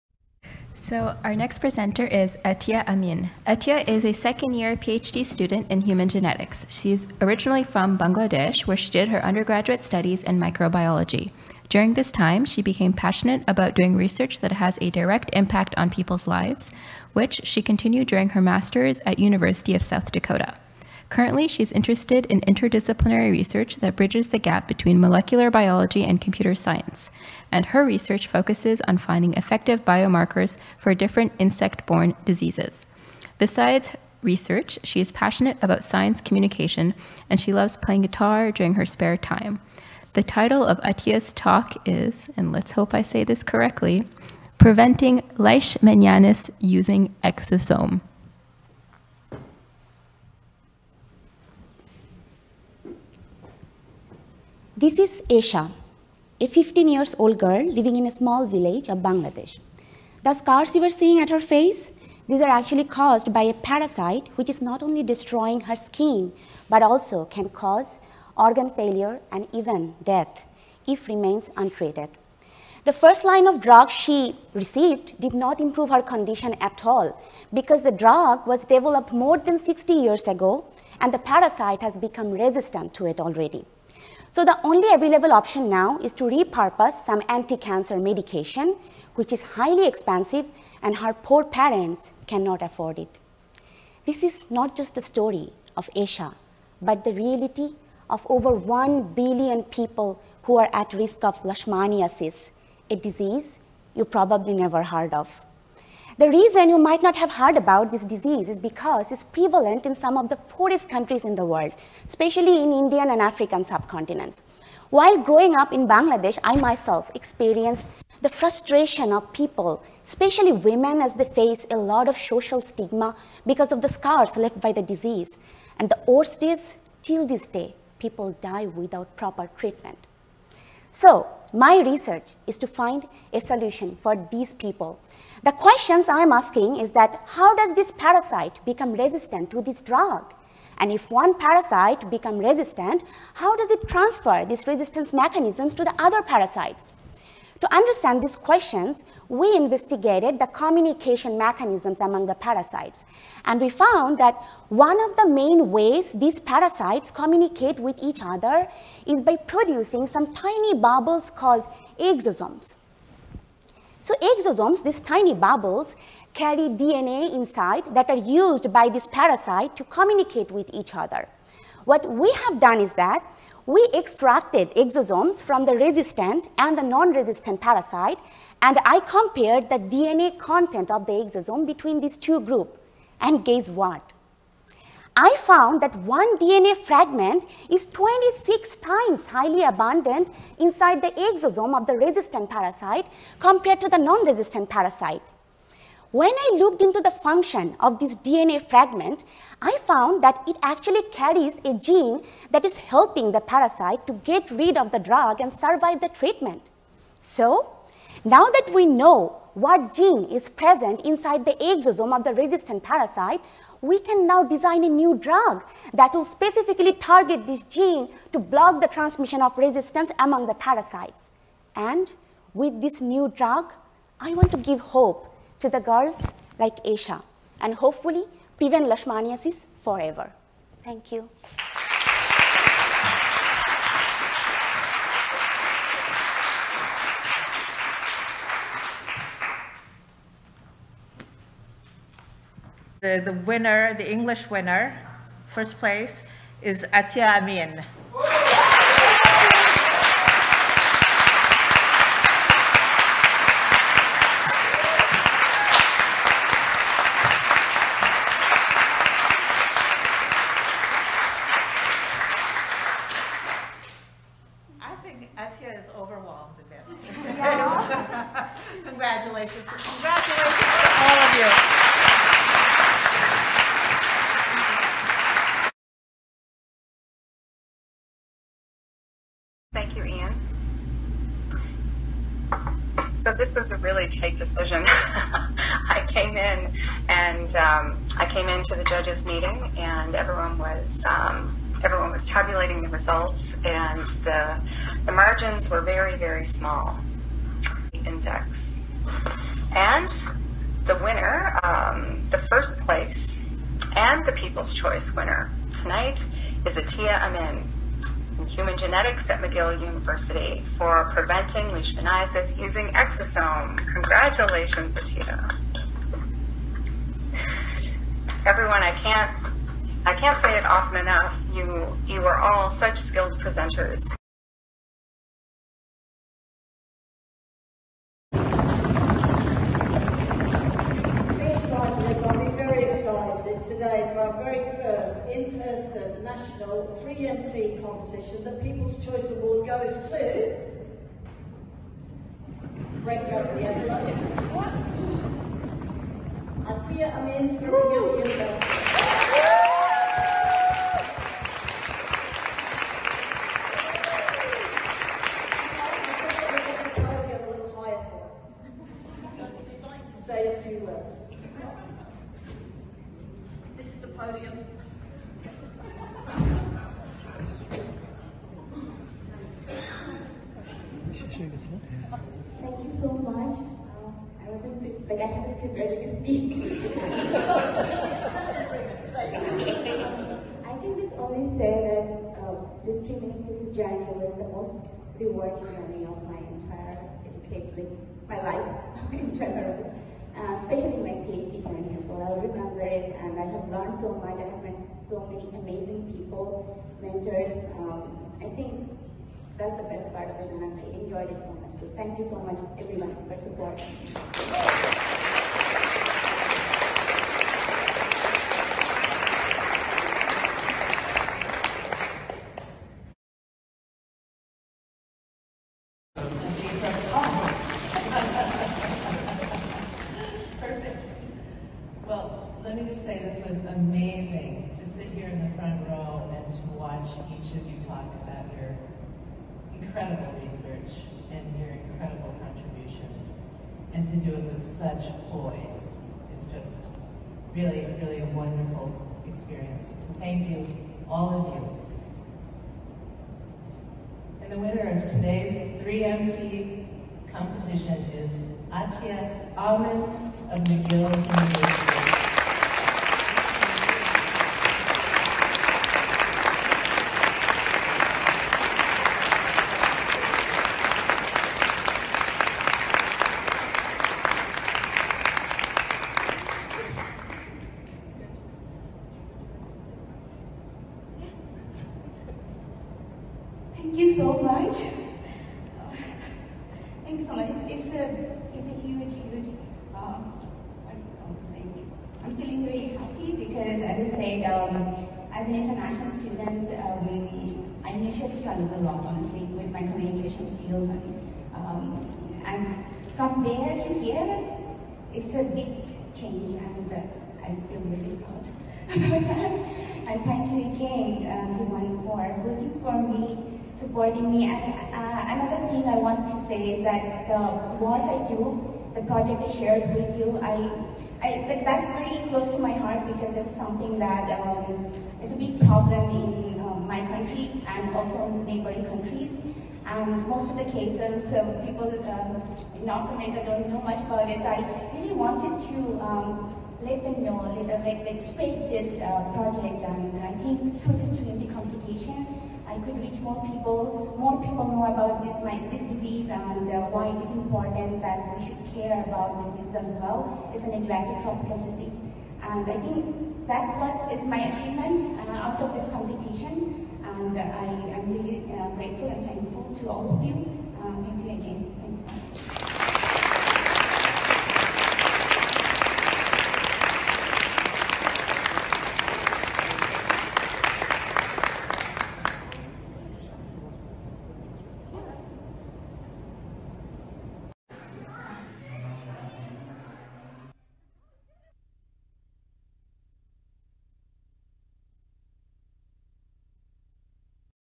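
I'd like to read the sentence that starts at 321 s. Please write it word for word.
You you are all such skilled presenters.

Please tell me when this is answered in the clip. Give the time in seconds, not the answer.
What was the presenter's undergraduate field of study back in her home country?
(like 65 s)
10 s.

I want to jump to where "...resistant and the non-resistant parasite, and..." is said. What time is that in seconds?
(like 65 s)
175 s.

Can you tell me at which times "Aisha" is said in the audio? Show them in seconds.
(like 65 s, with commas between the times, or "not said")
55 s, 95 s, 226 s.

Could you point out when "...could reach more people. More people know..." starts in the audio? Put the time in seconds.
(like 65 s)
532 s.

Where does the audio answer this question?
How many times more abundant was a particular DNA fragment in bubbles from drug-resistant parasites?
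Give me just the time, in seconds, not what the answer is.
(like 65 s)
187 s.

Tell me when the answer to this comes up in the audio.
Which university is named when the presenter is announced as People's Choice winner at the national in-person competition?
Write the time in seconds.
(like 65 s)
347 s.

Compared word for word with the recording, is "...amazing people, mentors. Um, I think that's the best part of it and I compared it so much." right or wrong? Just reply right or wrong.
wrong.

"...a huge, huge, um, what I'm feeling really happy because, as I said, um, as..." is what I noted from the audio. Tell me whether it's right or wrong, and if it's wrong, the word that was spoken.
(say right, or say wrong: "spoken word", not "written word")
right.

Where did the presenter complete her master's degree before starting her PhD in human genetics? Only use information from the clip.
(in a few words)
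University of South Dakota.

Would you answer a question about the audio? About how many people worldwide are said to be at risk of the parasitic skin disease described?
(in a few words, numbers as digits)
Over 1 billion.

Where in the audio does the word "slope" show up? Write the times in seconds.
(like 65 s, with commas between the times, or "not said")
not said.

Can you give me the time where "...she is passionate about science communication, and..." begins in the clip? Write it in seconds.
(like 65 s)
34 s.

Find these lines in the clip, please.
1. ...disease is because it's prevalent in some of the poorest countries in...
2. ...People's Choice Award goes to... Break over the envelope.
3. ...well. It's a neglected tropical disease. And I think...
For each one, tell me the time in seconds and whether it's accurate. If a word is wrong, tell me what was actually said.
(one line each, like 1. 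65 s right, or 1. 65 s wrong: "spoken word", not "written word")
1. 108 s right
2. 338 s right
3. 539 s right.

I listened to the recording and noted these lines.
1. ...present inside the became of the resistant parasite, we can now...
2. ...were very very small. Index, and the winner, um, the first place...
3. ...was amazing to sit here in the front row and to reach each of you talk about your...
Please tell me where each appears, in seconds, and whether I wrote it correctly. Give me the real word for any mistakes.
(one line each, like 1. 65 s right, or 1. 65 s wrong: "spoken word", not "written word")
1. 210 s wrong: "exosome", not "became"
2. 295 s right
3. 423 s wrong: "watch", not "reach".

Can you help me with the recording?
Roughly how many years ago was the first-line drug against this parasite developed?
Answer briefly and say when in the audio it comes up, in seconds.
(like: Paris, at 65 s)
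60, at 79 s.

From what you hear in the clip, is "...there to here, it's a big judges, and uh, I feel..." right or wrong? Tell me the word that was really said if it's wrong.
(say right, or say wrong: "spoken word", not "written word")
wrong: "change", not "judges".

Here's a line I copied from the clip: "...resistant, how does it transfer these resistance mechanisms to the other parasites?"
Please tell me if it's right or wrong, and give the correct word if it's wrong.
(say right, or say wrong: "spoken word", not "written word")
right.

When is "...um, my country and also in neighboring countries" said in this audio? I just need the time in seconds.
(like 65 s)
516 s.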